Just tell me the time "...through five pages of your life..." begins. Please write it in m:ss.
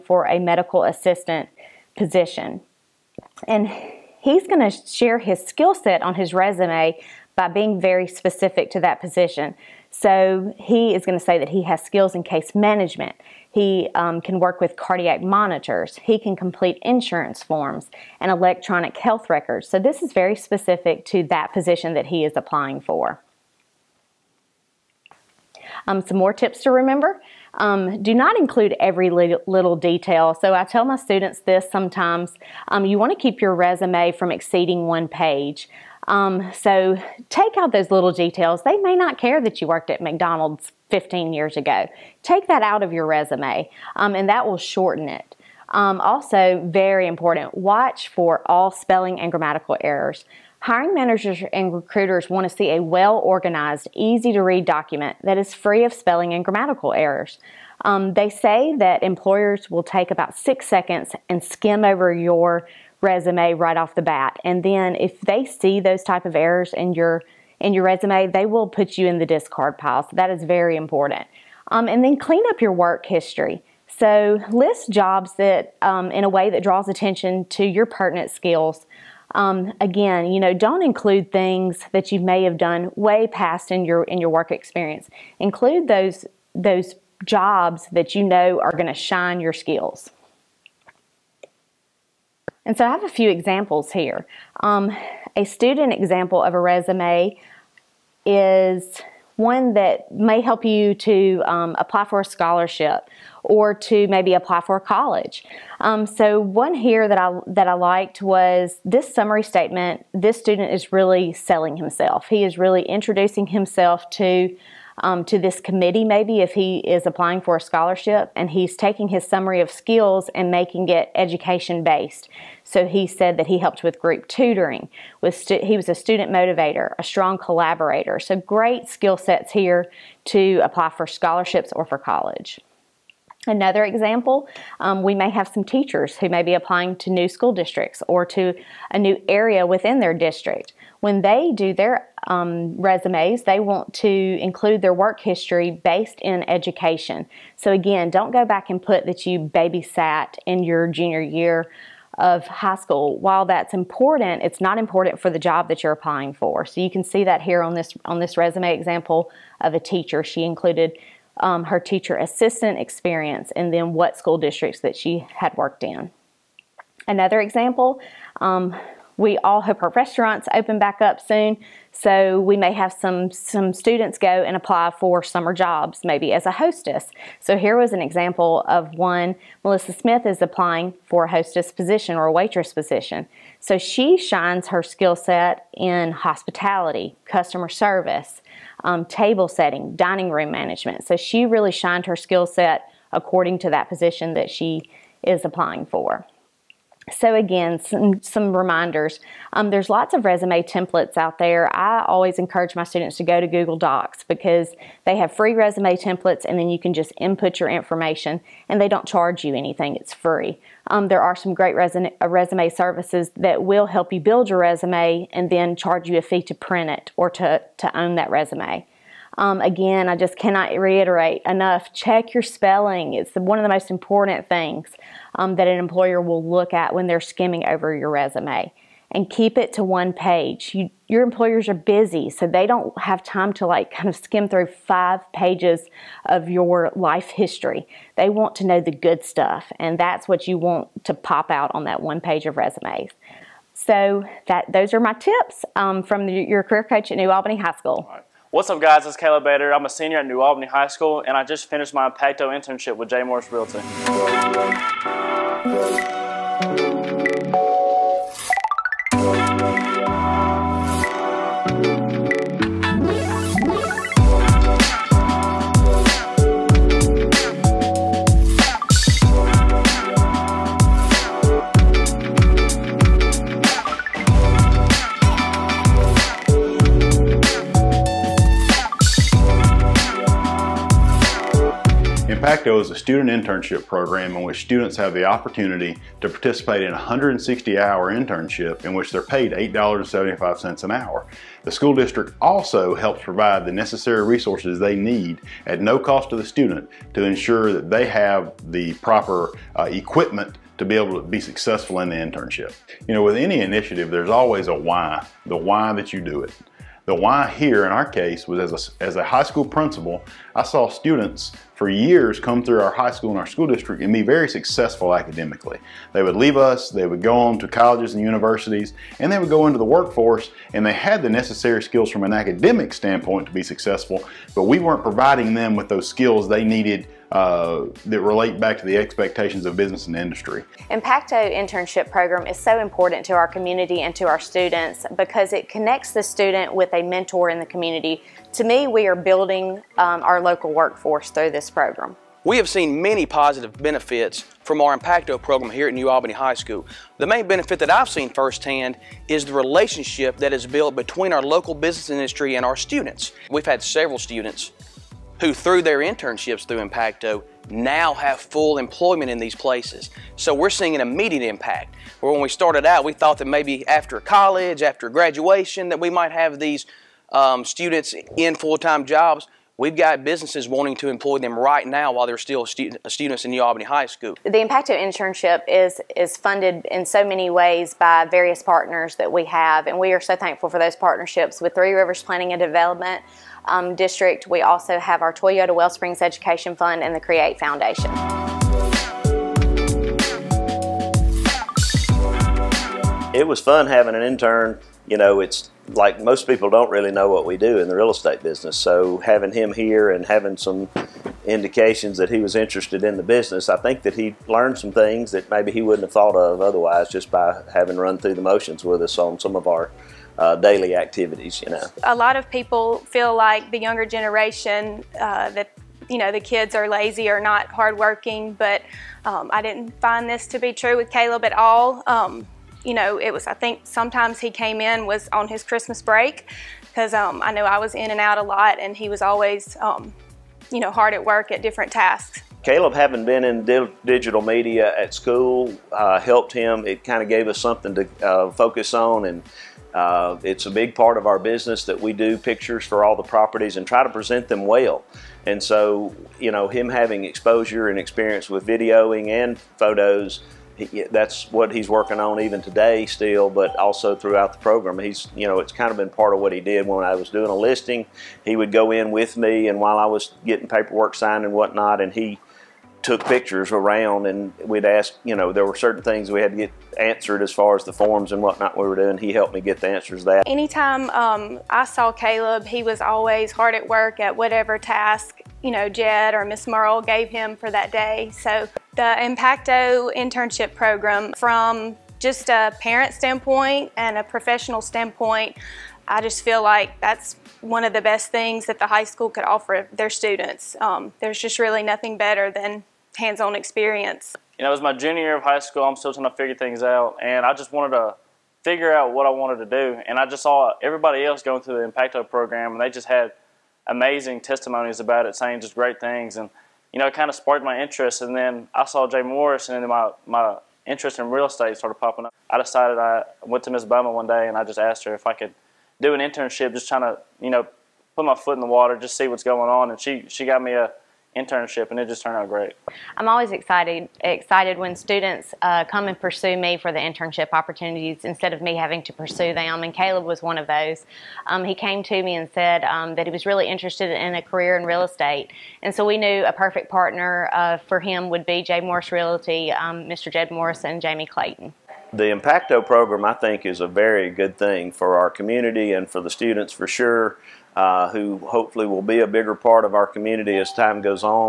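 3:54.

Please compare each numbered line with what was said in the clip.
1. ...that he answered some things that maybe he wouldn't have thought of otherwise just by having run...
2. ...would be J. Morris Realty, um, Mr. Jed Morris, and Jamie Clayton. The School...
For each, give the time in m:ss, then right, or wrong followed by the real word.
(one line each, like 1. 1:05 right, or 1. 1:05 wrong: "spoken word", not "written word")
1. 6:44 wrong: "learned", not "answered"
2. 8:58 wrong: "Impacto", not "School".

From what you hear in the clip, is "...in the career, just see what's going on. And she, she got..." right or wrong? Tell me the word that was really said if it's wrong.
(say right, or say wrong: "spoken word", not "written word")
wrong: "water", not "career".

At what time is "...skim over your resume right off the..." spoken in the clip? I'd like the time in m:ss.
1:01.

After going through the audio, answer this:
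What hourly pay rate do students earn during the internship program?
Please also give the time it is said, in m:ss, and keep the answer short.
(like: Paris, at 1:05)
$8.75, at 4:49.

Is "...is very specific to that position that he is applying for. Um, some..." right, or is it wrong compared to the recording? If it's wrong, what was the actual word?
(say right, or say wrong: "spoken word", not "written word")
right.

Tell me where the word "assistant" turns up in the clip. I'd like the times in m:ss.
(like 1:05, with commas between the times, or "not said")
0:00, 2:42.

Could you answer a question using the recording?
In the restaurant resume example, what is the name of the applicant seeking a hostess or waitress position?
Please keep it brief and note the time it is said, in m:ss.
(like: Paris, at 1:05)
Melissa Smith, at 2:59.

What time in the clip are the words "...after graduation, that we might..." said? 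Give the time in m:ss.
6:04.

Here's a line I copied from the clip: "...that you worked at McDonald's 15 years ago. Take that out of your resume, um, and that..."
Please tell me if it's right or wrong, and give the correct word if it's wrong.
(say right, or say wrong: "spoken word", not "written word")
right.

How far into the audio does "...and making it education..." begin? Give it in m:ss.
2:00.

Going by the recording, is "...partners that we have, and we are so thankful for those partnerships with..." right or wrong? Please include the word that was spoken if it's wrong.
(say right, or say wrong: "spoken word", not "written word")
right.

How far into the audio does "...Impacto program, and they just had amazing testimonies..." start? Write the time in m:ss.
8:21.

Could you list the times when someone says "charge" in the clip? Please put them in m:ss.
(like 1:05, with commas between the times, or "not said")
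3:29, 3:35.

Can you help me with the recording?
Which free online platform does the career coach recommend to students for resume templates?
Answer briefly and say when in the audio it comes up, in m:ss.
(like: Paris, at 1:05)
Google Docs, at 3:23.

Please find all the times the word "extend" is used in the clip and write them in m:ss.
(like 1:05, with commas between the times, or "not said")
not said.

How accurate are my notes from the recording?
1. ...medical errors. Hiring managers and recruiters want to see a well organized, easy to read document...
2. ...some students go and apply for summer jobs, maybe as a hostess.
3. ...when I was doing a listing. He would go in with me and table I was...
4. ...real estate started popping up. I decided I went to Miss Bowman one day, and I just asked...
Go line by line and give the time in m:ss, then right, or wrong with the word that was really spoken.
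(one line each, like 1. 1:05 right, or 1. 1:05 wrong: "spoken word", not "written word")
1. 0:49 wrong: "grammatical", not "medical"
2. 2:53 right
3. 7:36 wrong: "while", not "table"
4. 8:31 right.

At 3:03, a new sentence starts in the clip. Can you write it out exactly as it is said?
So she shines her skill set in hospitality, customer service, um, table setting, dining room management.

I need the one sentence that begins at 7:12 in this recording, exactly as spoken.
Caleb, having been in di digital media at school, uh, helped him.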